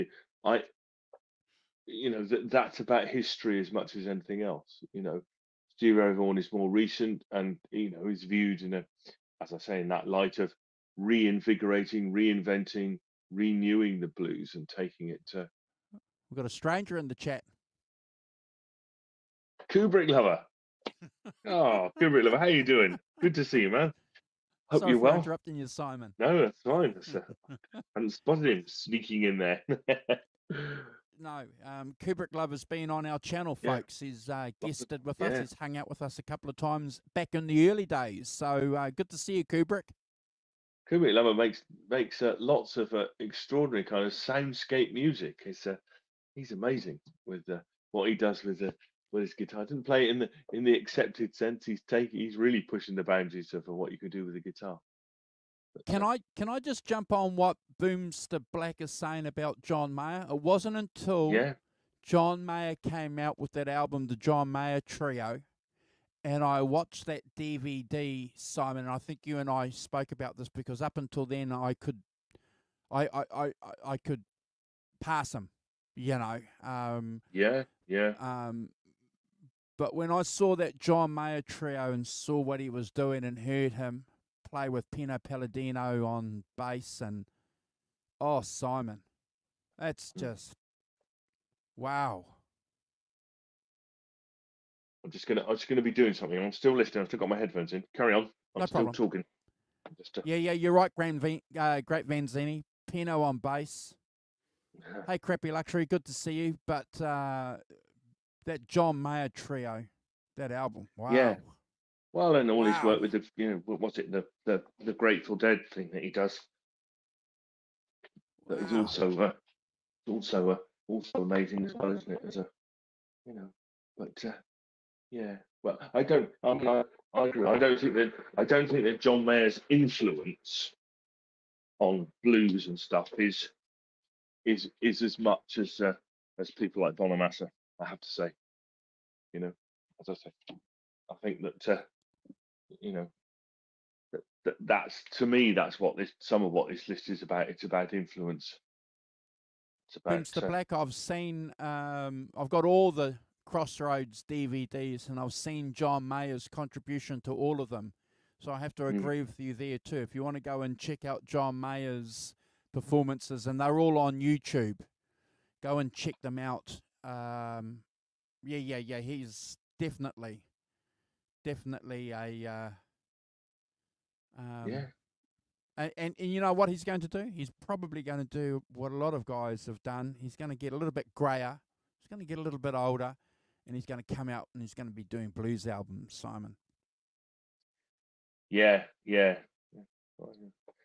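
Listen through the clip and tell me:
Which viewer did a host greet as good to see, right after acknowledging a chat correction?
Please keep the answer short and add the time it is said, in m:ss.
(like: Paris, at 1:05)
crappy luxury, at 1:45.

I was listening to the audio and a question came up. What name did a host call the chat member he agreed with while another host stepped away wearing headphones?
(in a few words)
Great Vanzini.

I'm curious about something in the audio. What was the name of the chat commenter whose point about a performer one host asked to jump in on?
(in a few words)
Boomster Black.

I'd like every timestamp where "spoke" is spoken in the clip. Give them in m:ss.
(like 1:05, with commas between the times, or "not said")
1:09.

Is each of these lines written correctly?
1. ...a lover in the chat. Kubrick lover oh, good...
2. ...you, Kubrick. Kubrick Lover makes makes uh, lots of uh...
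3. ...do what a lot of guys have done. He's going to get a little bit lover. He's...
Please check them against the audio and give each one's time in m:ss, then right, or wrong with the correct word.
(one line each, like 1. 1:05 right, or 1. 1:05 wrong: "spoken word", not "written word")
1. 0:16 wrong: "stranger", not "lover"
2. 0:39 right
3. 2:58 wrong: "grayer", not "lover".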